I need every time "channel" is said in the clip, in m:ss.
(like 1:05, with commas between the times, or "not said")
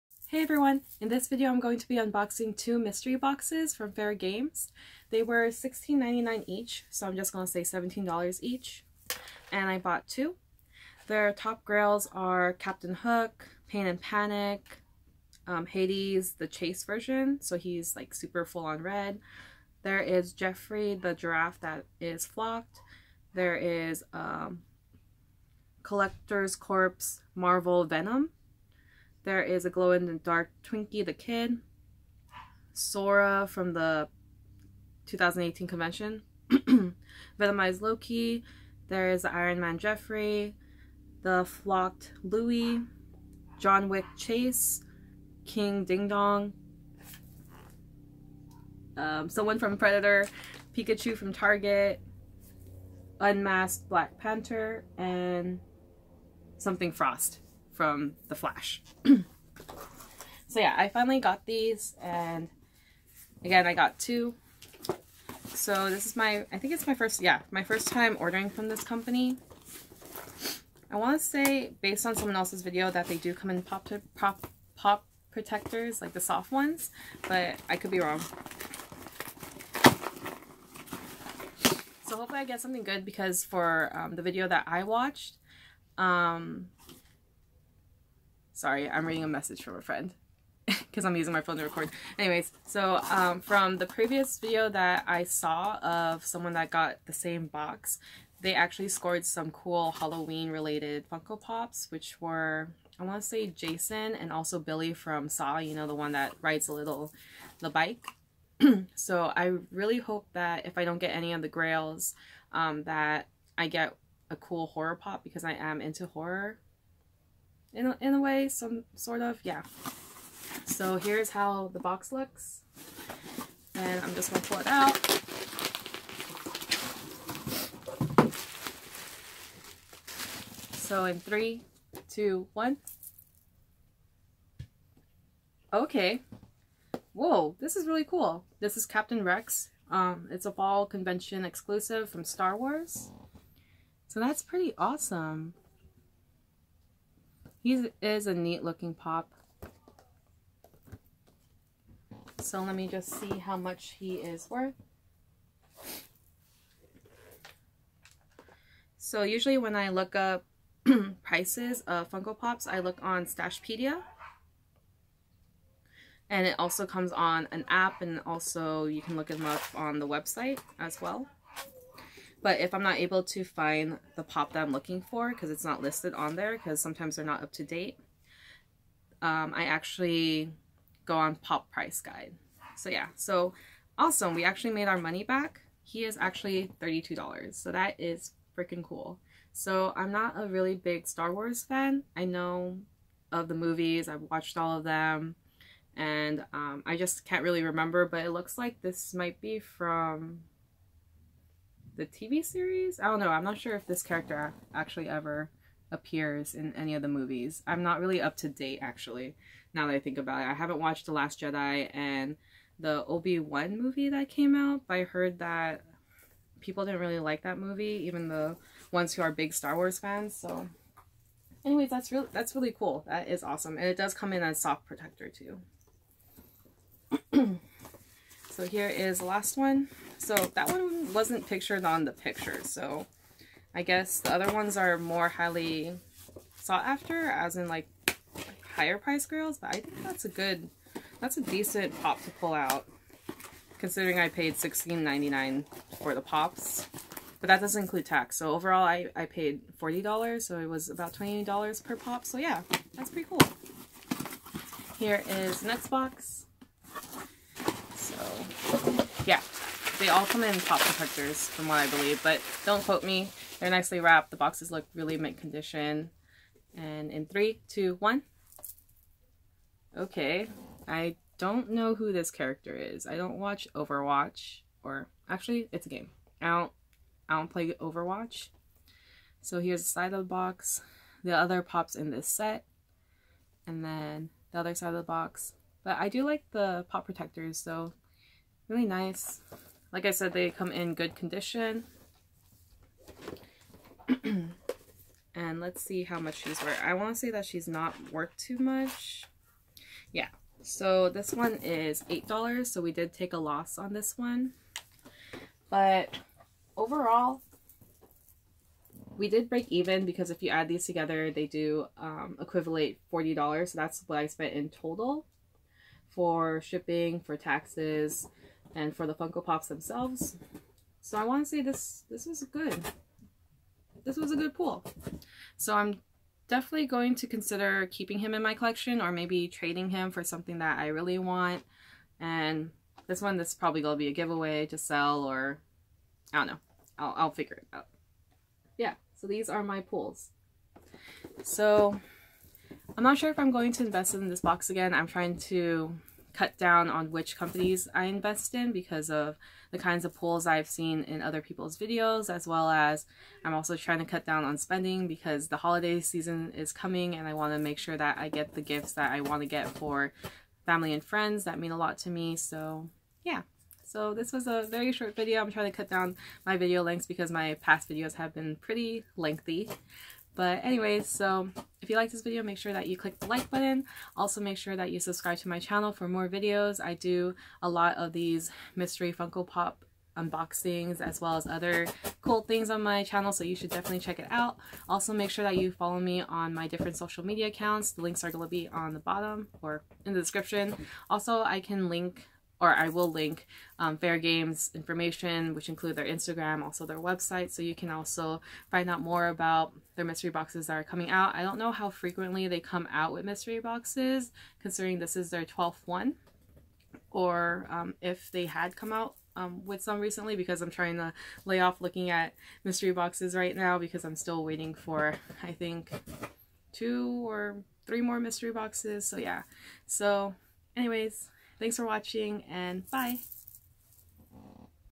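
6:15, 6:23.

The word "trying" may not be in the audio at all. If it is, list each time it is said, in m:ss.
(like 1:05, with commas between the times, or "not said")
5:45, 5:53, 6:05, 6:50.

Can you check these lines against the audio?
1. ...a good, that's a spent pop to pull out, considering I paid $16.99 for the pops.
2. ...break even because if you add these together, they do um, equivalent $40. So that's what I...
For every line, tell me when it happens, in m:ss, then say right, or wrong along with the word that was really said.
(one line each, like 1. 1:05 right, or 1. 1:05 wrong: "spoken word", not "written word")
1. 4:00 wrong: "decent", not "spent"
2. 5:09 right.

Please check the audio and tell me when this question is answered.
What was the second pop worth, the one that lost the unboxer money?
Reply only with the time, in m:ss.
5:02.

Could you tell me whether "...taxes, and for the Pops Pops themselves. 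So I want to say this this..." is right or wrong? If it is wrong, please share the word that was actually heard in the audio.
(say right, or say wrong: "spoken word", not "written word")
wrong: "Funko", not "Pops".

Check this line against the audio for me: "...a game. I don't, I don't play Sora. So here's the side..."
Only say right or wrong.
wrong.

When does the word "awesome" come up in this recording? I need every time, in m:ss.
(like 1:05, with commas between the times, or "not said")
2:24, 3:03, 3:43.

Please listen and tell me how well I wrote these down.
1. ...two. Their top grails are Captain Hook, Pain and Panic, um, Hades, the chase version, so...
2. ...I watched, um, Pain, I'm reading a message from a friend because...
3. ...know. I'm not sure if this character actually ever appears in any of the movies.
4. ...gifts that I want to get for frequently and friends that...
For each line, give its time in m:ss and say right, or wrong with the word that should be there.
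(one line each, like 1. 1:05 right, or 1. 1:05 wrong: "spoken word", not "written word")
1. 0:10 right
2. 1:24 wrong: "Sorry", not "Pain"
3. 3:23 right
4. 5:58 wrong: "family", not "frequently".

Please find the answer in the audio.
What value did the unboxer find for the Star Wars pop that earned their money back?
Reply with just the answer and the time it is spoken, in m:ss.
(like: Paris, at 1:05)
$32, at 3:06.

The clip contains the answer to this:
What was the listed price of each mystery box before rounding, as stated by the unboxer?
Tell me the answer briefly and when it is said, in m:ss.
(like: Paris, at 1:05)
$16.99, at 0:05.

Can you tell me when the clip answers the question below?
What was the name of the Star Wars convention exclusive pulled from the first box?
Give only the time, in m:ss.
2:18.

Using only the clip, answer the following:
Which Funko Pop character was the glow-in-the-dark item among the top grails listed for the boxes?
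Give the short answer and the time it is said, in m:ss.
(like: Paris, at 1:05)
Twinkie the Kid, at 0:30.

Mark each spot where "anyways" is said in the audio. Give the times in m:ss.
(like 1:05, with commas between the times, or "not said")
1:32, 3:41, 6:10, 7:00.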